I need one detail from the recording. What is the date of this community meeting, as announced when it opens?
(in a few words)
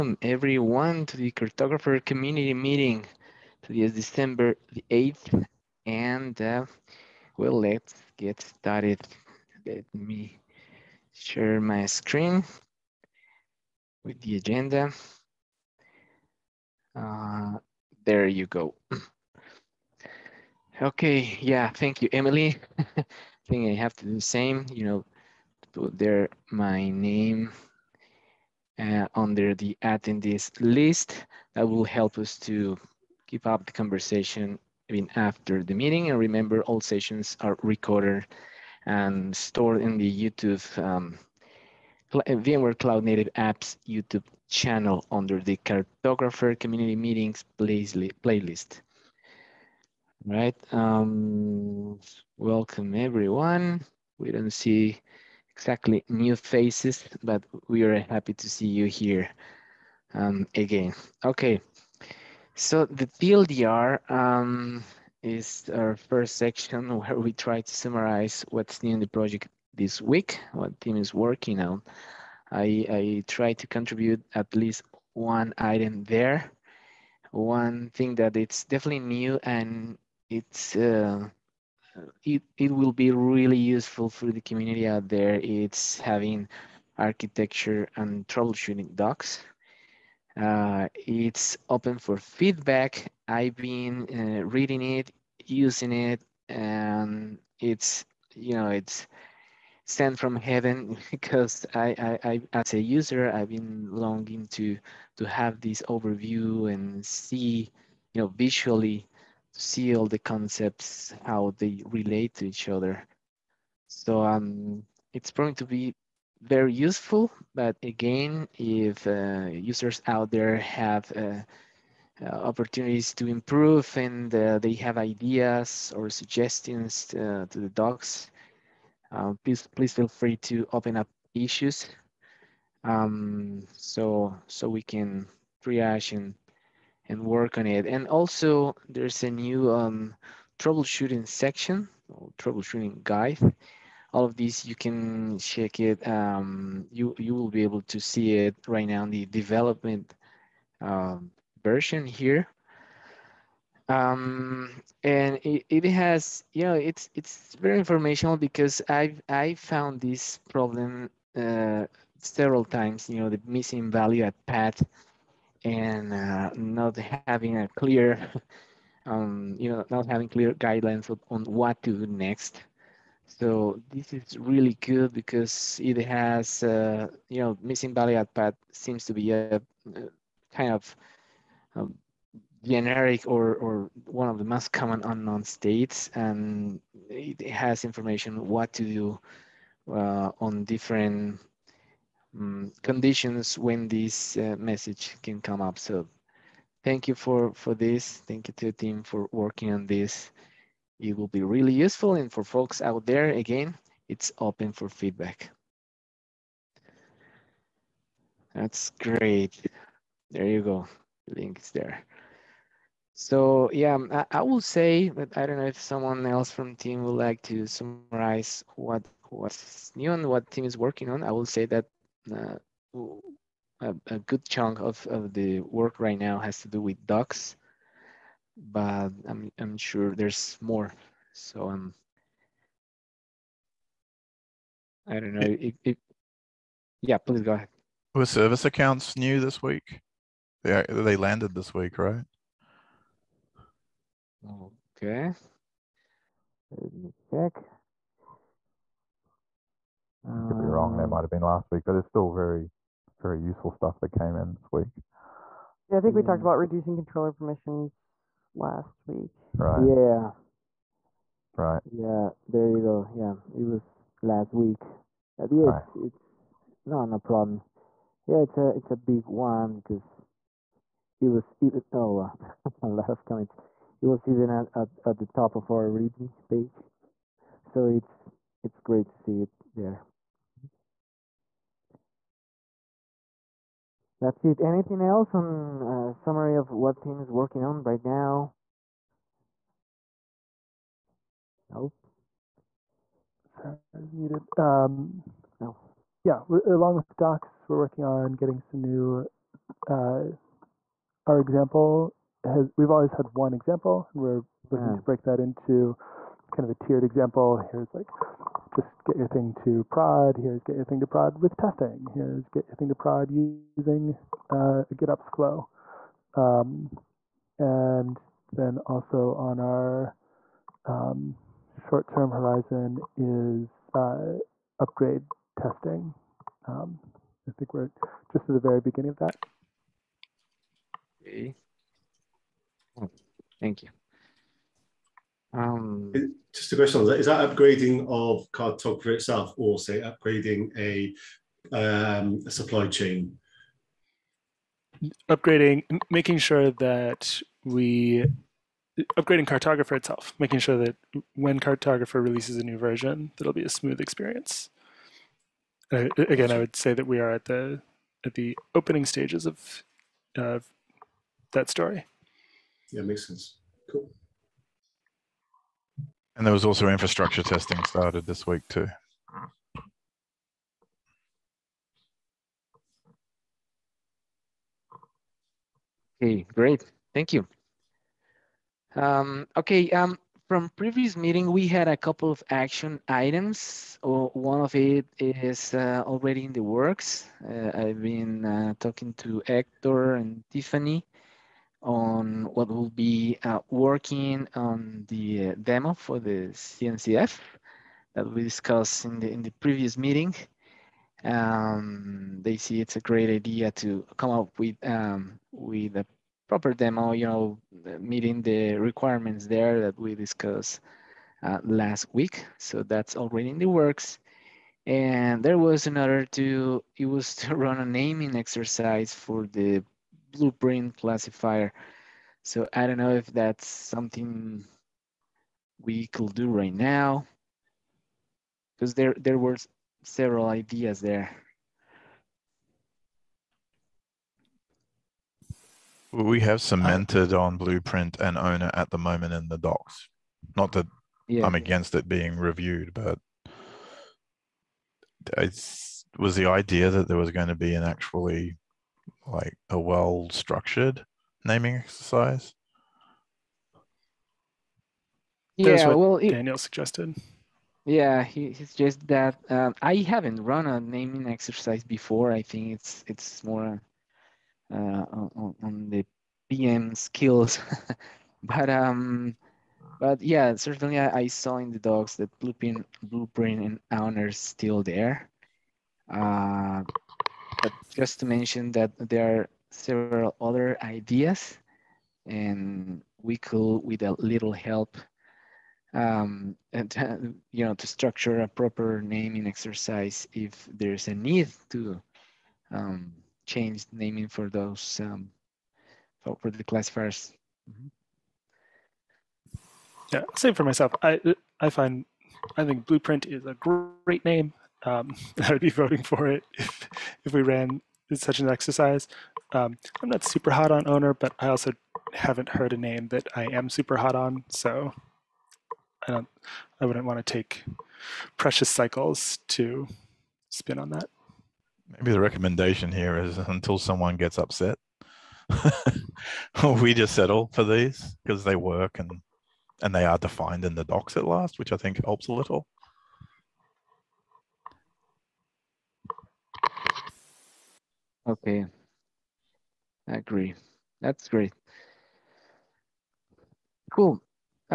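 December 8th.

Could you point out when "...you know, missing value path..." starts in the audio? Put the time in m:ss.
2:57.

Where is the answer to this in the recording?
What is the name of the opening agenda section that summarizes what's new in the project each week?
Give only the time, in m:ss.
1:03.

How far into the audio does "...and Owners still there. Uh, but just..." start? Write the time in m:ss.
7:53.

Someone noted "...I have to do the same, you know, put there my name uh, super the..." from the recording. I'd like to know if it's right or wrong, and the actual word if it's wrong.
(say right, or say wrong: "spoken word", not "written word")
wrong: "under", not "super".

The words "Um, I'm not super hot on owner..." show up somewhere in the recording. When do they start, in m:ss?
8:29.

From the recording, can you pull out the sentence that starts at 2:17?
And also there's a new um, troubleshooting section or troubleshooting guide.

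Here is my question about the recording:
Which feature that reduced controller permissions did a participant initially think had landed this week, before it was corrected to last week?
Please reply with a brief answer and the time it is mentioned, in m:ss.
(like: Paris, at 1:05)
service accounts, at 3:58.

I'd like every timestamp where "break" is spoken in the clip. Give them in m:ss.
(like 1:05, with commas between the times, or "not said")
5:05.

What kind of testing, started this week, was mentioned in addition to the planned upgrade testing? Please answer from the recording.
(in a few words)
infrastructure testing.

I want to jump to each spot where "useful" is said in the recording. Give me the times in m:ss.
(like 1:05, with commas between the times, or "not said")
1:23, 1:56, 3:21, 4:13.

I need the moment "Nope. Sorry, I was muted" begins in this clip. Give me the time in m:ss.
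4:51.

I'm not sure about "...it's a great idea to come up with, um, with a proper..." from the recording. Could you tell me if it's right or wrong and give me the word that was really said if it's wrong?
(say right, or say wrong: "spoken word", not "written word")
right.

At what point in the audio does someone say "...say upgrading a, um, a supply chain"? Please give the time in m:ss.
5:39.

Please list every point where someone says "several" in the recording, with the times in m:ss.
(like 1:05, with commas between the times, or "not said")
2:42, 7:10, 7:59.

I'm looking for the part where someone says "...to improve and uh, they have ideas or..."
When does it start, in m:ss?
2:03.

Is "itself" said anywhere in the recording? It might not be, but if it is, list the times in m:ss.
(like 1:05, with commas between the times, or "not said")
5:39, 5:49.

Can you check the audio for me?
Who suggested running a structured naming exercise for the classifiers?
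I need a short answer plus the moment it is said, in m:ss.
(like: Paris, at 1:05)
Daniel, at 7:36.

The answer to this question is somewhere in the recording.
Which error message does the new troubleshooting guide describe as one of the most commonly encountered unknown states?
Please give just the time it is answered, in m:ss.
2:43.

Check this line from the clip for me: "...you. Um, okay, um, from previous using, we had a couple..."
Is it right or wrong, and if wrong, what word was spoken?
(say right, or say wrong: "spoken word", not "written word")
wrong: "meeting", not "using".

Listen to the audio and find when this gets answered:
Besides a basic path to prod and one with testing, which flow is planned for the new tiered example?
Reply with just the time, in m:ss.
5:14.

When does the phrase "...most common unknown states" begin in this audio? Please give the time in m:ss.
3:04.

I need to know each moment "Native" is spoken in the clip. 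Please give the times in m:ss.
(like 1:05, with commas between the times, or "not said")
0:43.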